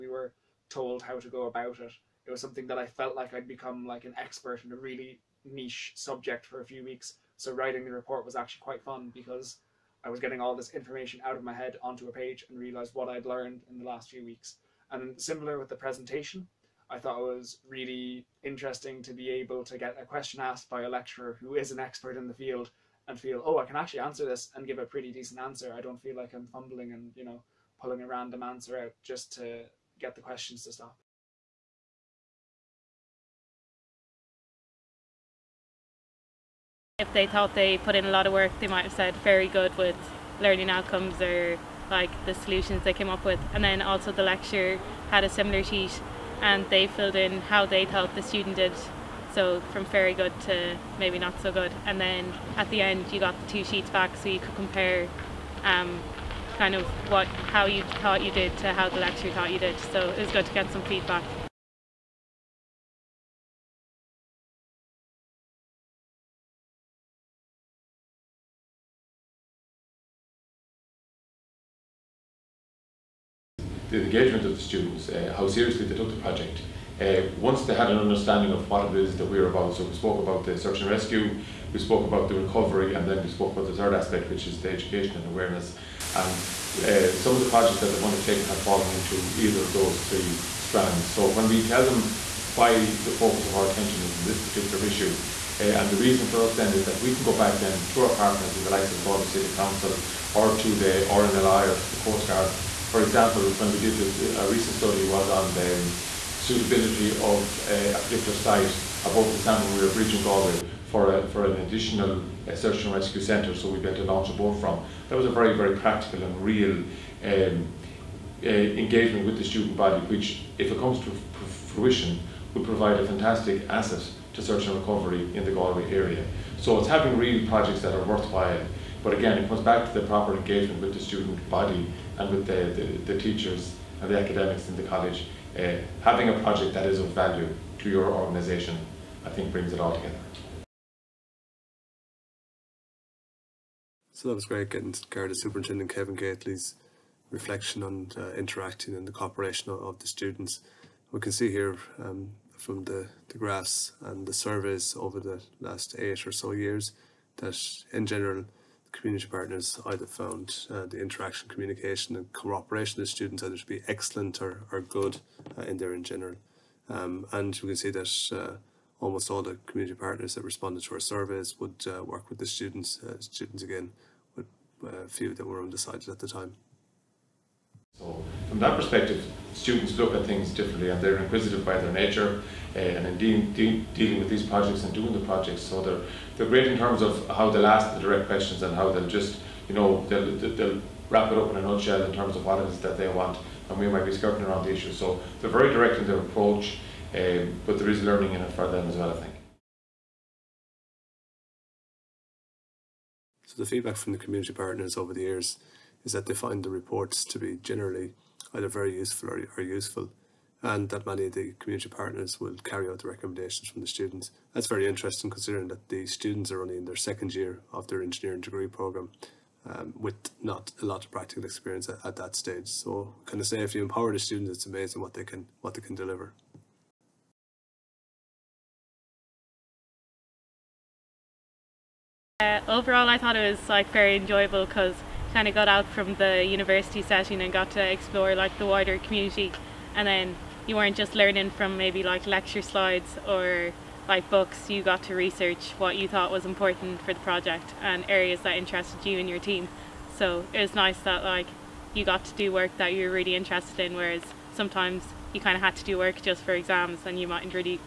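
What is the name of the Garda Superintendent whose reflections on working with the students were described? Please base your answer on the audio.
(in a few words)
Kevin Gately.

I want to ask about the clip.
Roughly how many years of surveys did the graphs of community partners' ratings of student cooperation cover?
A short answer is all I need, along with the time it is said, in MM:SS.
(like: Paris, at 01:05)
8, at 02:35.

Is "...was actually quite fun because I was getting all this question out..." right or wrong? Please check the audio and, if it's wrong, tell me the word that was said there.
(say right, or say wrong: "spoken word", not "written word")
wrong: "information", not "question".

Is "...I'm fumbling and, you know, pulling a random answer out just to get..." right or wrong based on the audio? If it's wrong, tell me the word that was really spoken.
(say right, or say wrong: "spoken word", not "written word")
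right.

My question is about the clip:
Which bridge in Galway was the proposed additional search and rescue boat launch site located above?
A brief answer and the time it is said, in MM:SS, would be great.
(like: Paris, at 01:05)
Salmon Weir Bridge, at 01:49.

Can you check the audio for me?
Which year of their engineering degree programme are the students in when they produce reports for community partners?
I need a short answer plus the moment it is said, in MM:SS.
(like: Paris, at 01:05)
Second year, at 03:36.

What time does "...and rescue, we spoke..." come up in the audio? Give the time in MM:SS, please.
01:20.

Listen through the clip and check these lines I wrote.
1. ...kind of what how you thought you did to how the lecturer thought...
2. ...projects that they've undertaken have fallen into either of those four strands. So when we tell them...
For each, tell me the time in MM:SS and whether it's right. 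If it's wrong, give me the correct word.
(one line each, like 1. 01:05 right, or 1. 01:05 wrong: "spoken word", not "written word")
1. 00:56 right
2. 01:27 wrong: "three", not "four".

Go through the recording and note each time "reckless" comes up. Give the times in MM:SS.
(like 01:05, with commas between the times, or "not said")
not said.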